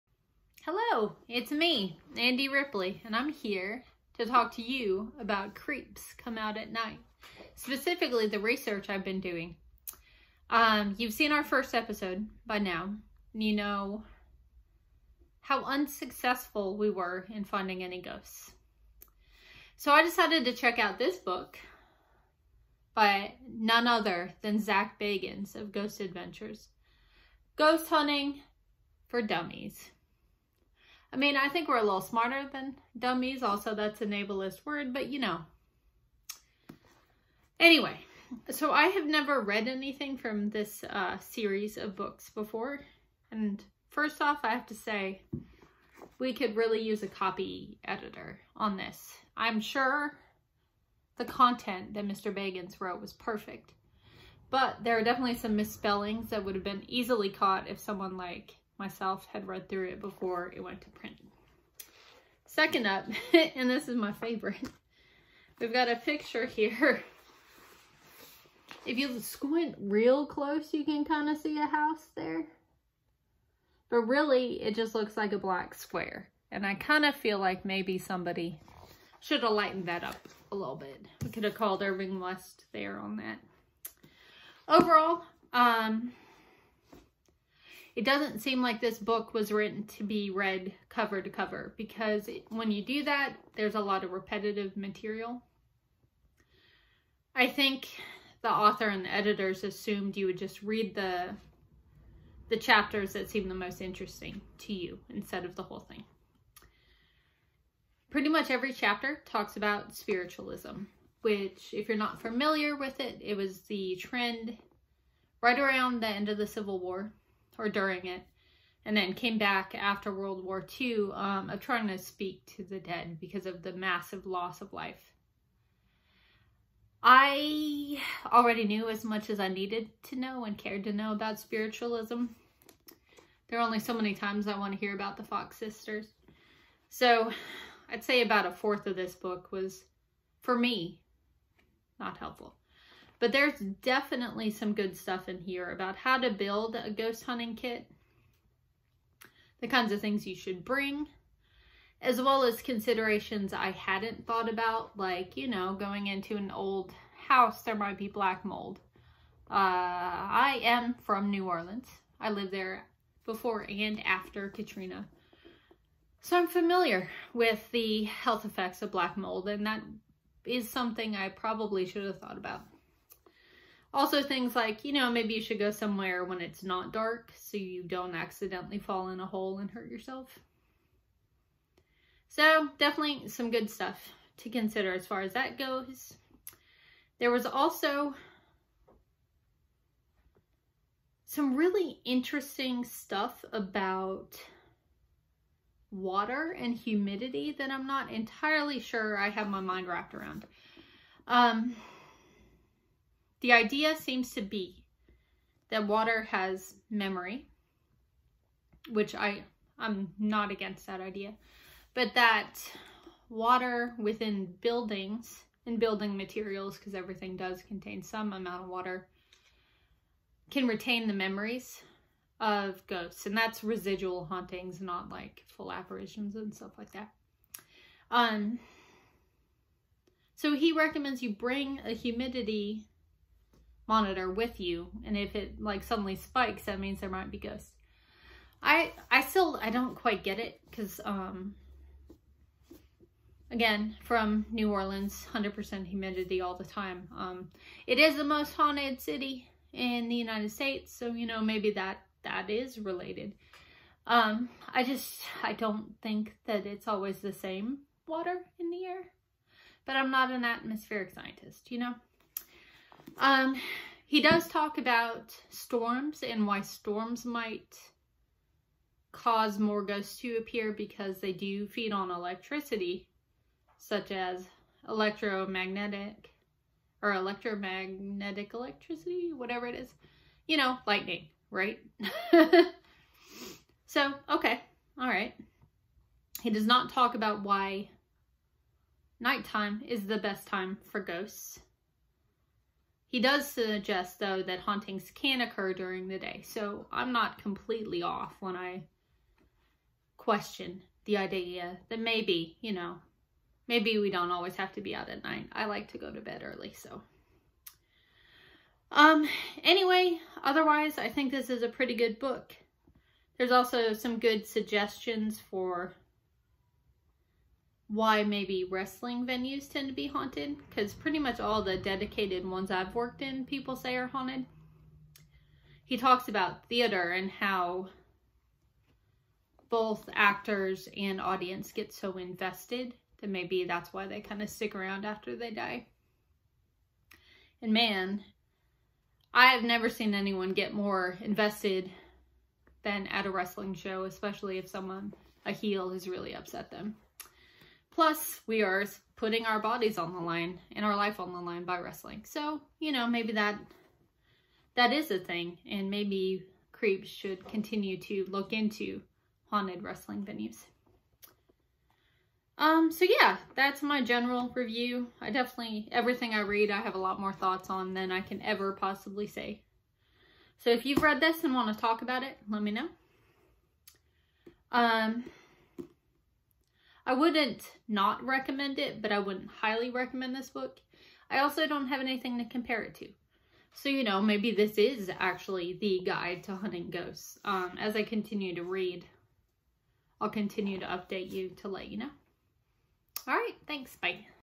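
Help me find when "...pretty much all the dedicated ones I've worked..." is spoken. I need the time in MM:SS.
05:20.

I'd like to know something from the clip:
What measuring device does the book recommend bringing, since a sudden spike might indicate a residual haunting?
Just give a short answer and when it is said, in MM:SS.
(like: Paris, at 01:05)
humidity monitor, at 03:51.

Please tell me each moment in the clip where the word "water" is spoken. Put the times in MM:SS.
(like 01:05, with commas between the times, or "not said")
03:15, 03:25, 03:33, 03:38, 04:18.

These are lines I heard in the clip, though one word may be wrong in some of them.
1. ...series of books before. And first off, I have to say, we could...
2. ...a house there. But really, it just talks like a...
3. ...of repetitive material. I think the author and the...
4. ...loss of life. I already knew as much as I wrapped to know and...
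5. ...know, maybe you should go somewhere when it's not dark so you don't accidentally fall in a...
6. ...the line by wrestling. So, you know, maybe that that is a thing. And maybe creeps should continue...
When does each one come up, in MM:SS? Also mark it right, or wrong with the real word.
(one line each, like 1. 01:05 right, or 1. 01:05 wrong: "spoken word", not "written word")
1. 00:41 right
2. 01:11 wrong: "looks", not "talks"
3. 01:34 right
4. 02:04 wrong: "needed", not "wrapped"
5. 02:54 right
6. 05:51 right.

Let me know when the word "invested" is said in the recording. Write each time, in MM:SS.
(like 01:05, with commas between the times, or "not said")
05:32, 05:41.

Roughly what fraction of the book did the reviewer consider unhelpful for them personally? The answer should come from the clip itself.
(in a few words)
a fourth.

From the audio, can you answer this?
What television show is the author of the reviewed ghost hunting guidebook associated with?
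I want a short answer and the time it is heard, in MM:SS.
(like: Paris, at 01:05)
Ghost Adventures, at 00:25.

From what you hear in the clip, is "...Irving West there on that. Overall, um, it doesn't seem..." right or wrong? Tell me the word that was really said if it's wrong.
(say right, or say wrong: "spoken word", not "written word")
right.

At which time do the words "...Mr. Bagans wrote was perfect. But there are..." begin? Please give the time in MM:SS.
00:52.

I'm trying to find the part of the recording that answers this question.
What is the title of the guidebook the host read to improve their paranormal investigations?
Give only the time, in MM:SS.
00:27.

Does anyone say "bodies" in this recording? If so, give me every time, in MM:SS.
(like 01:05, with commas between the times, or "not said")
05:49.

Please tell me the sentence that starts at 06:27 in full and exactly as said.
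Um, as I continue to read, I'll continue to update you to let you know.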